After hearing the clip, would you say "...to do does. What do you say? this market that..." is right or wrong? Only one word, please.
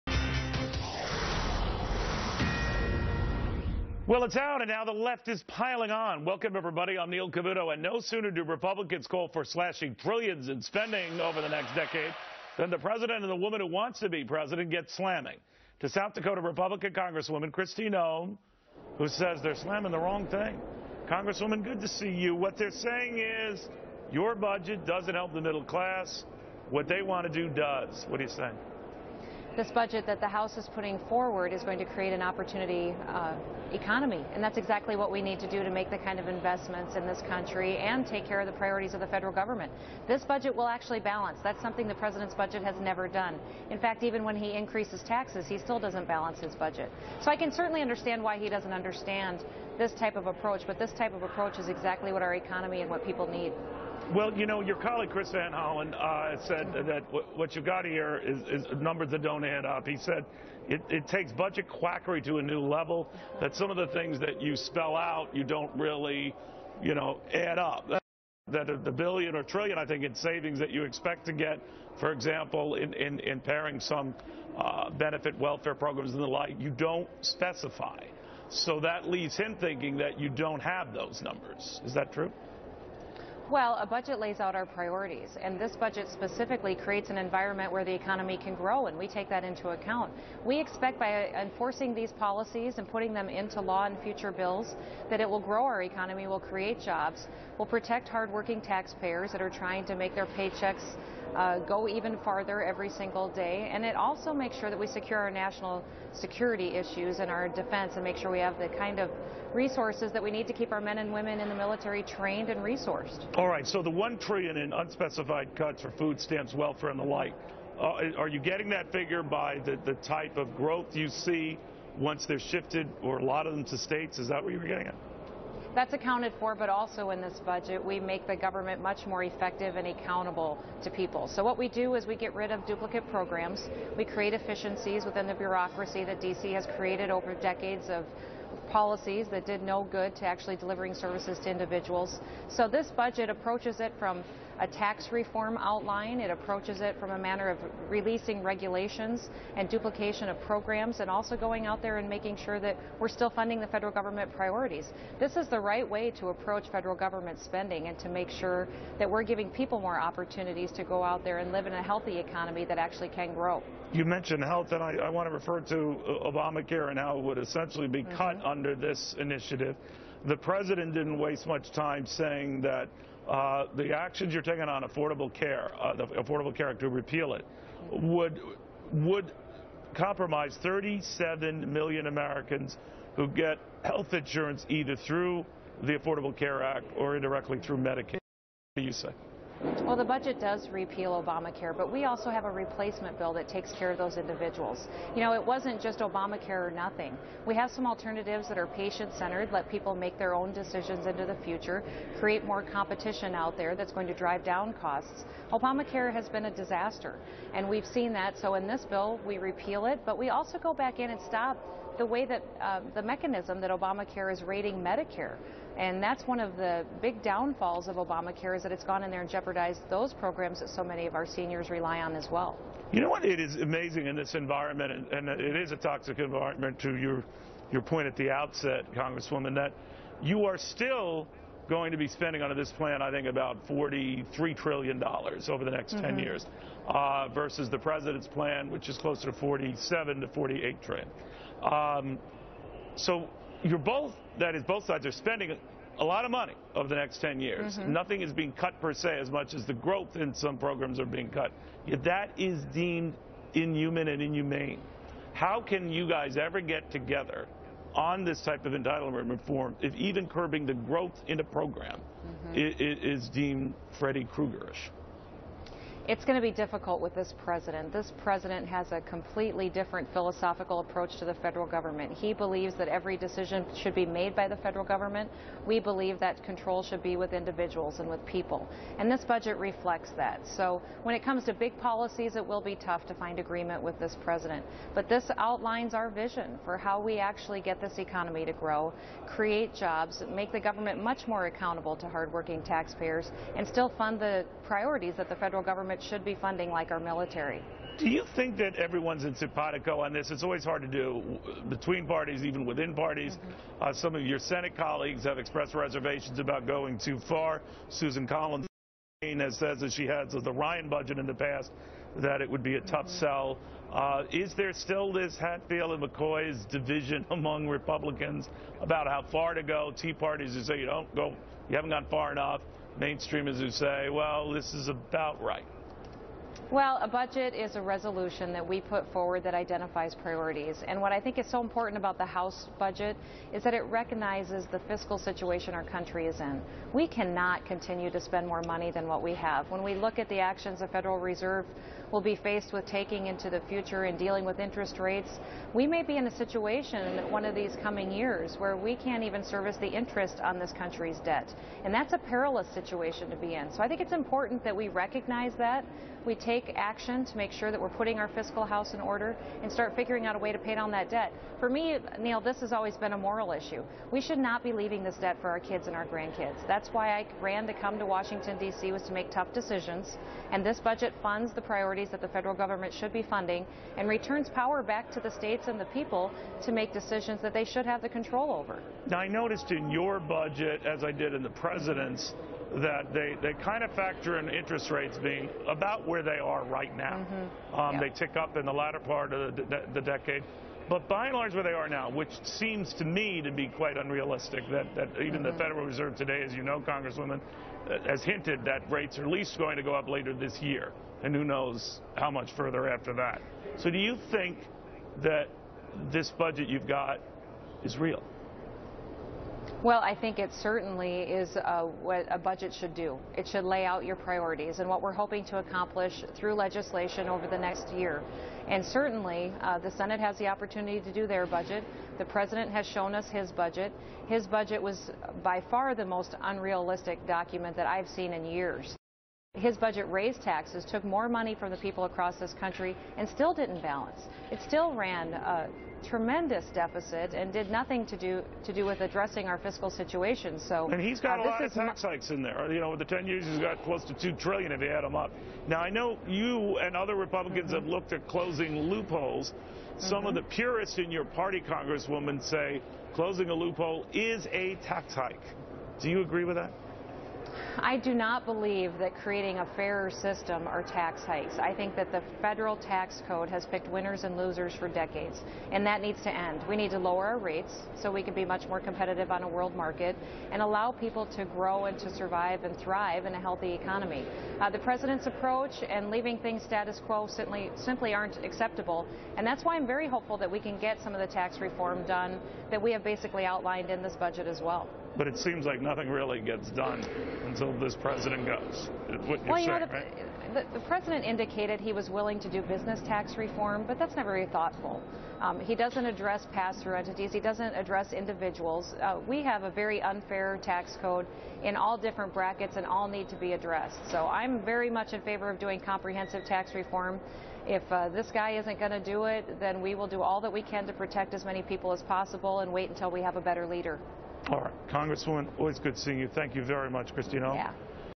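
wrong.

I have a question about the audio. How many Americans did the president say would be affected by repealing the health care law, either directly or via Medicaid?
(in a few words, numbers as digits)
37 million.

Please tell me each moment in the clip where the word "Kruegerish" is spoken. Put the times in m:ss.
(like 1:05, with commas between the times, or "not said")
4:24.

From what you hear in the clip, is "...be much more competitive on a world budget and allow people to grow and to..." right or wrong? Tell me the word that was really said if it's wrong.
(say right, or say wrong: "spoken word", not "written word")
wrong: "market", not "budget".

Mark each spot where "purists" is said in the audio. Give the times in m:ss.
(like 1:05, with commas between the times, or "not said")
7:30.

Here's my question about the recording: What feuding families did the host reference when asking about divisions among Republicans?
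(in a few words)
Hatfield and McCoy.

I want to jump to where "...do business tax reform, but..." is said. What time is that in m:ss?
8:12.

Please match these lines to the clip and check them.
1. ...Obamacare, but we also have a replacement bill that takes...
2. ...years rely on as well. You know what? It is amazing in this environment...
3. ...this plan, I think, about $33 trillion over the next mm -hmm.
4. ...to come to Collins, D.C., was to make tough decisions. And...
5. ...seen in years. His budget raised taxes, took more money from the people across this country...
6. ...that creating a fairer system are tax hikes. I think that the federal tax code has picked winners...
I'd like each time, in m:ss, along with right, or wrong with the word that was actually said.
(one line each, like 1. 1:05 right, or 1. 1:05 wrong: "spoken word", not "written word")
1. 3:11 right
2. 3:41 wrong: "seniors", not "years"
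3. 3:52 wrong: "43", not "33"
4. 6:07 wrong: "Washington", not "Collins"
5. 7:08 right
6. 7:38 right.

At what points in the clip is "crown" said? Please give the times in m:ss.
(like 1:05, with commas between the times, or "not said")
not said.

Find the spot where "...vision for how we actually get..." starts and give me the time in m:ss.
4:46.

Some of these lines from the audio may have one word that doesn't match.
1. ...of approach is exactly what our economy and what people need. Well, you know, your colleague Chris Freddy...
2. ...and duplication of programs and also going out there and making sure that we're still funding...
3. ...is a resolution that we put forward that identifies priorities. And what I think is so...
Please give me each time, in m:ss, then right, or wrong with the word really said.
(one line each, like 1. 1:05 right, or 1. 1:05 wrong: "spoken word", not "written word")
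1. 0:51 wrong: "Van", not "Freddy"
2. 2:29 right
3. 5:27 right.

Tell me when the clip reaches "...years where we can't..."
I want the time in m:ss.
5:48.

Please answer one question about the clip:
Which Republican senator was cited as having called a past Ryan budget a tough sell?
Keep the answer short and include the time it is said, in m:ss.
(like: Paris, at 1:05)
Susan Collins, at 5:07.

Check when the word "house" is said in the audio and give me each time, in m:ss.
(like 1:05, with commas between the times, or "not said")
0:30, 5:32, 5:58.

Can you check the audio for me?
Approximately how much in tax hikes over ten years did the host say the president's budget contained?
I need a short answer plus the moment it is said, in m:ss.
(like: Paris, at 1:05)
2 trillion, at 7:24.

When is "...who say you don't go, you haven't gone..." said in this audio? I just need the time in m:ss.
5:20.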